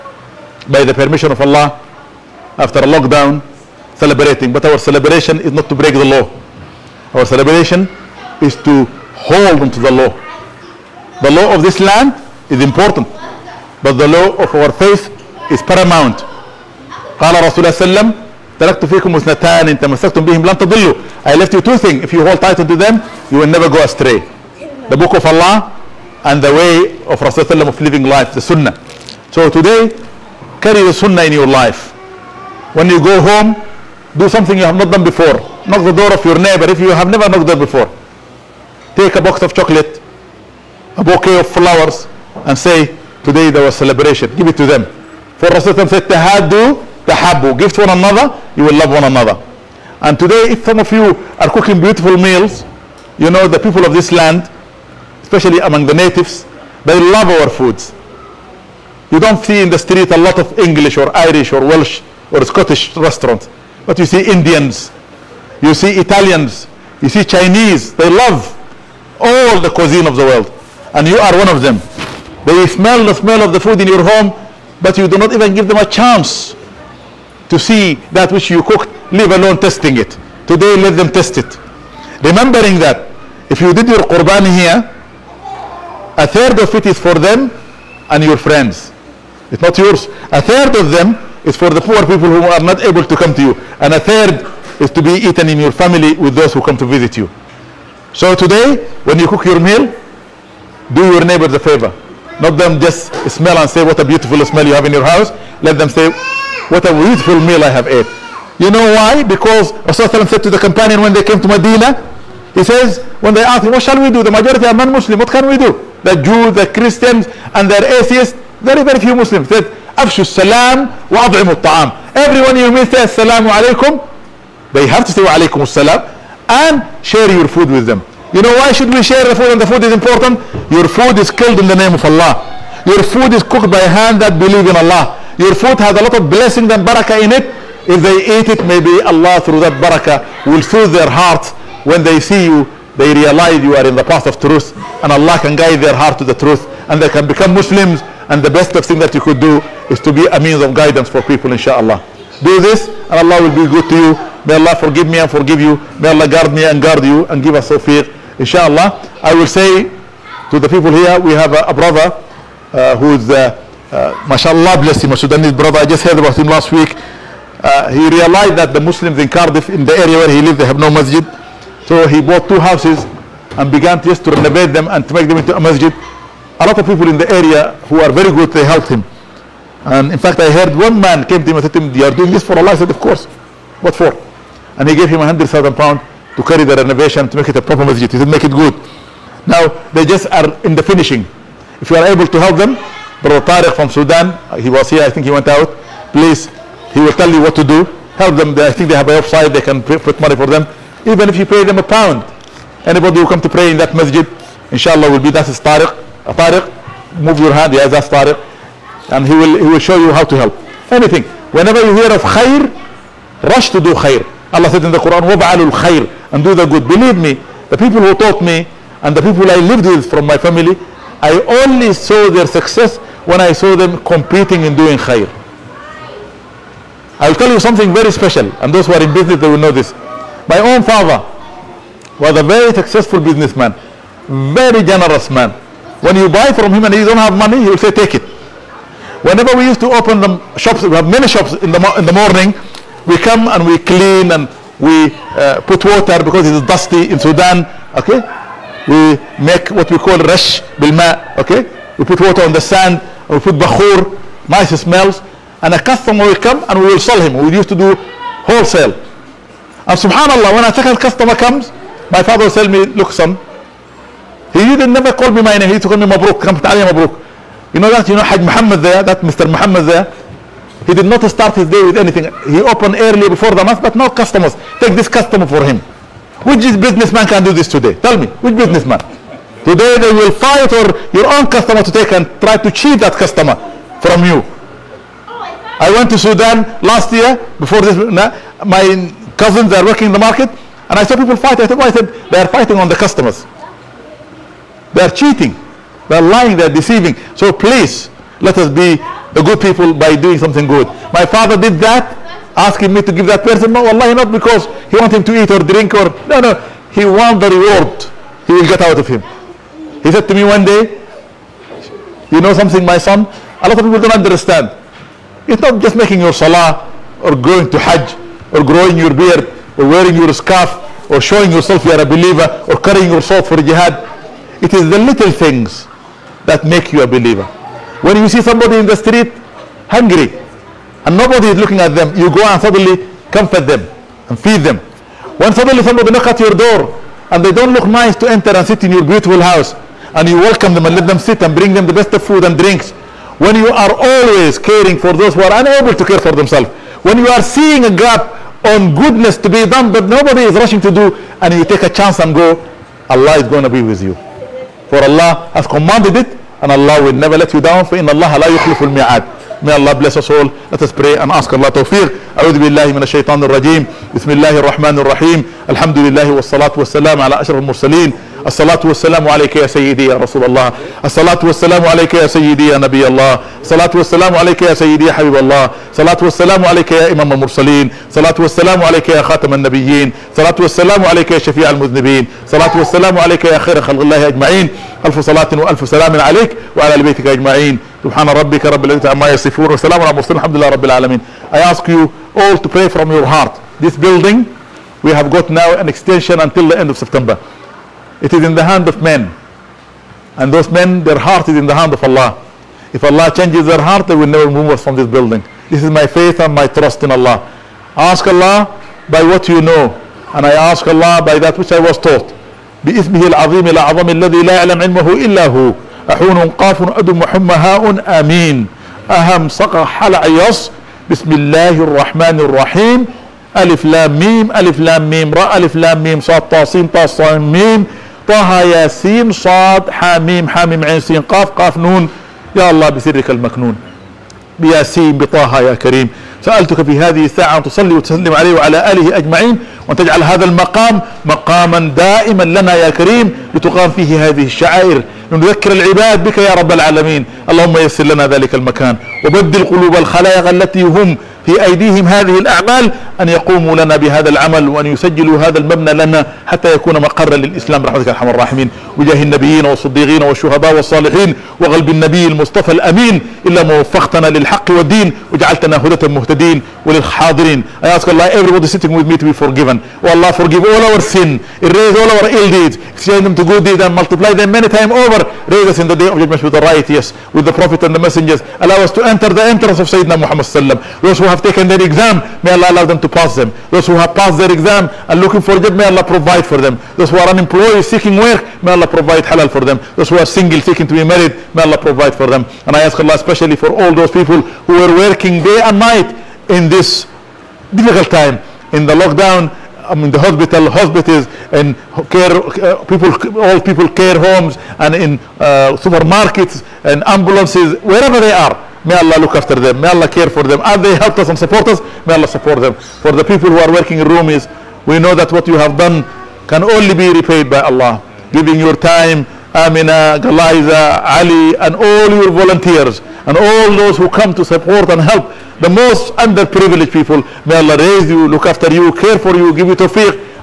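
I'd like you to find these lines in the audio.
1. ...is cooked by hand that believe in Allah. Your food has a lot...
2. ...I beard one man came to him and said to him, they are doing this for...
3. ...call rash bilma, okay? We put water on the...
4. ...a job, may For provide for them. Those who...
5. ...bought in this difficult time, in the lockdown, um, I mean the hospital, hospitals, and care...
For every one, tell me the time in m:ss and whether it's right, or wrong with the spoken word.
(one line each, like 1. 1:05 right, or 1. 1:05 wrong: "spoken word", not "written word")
1. 2:13 right
2. 3:00 wrong: "heard", not "beard"
3. 4:09 right
4. 8:05 wrong: "Allah", not "For"
5. 8:15 wrong: "night", not "bought".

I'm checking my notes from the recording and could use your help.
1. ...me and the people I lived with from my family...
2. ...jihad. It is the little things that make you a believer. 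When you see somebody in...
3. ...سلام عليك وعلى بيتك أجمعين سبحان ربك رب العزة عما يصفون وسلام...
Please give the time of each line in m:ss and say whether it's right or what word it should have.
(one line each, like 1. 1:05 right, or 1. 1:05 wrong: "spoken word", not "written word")
1. 3:38 right
2. 5:23 right
3. 6:25 right.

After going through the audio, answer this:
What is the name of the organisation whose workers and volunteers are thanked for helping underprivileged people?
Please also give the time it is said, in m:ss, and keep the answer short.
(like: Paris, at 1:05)
Rumi's, at 8:34.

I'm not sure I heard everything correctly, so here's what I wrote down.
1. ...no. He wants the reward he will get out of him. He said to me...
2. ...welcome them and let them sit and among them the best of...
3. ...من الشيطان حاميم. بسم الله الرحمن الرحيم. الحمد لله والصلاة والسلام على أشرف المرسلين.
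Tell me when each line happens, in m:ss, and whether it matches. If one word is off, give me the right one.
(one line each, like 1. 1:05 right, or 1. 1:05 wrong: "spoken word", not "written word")
1. 5:06 right
2. 5:40 wrong: "bring", not "among"
3. 6:02 wrong: "الرجيم", not "حاميم".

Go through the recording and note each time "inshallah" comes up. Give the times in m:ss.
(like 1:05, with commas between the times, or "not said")
2:31, 2:38, 3:24.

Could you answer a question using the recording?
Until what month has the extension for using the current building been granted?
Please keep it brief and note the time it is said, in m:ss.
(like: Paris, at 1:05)
September, at 6:36.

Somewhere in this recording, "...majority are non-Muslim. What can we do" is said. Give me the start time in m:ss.
1:54.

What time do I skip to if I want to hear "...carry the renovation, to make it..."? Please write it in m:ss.
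3:06.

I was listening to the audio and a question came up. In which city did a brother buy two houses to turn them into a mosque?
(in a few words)
Cardiff.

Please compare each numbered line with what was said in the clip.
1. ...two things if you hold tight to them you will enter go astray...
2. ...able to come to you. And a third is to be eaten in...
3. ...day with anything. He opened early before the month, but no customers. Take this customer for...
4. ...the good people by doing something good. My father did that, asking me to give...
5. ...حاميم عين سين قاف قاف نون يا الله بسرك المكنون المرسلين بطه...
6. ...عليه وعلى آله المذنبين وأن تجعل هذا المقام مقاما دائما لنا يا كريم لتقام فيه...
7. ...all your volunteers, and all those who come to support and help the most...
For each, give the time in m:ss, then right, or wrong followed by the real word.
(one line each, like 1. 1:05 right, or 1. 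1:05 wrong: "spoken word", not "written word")
1. 0:21 wrong: "never", not "enter"
2. 1:32 right
3. 4:31 right
4. 4:59 right
5. 7:10 wrong: "بياسين", not "المرسلين"
6. 7:18 wrong: "أجمعين", not "المذنبين"
7. 8:41 right.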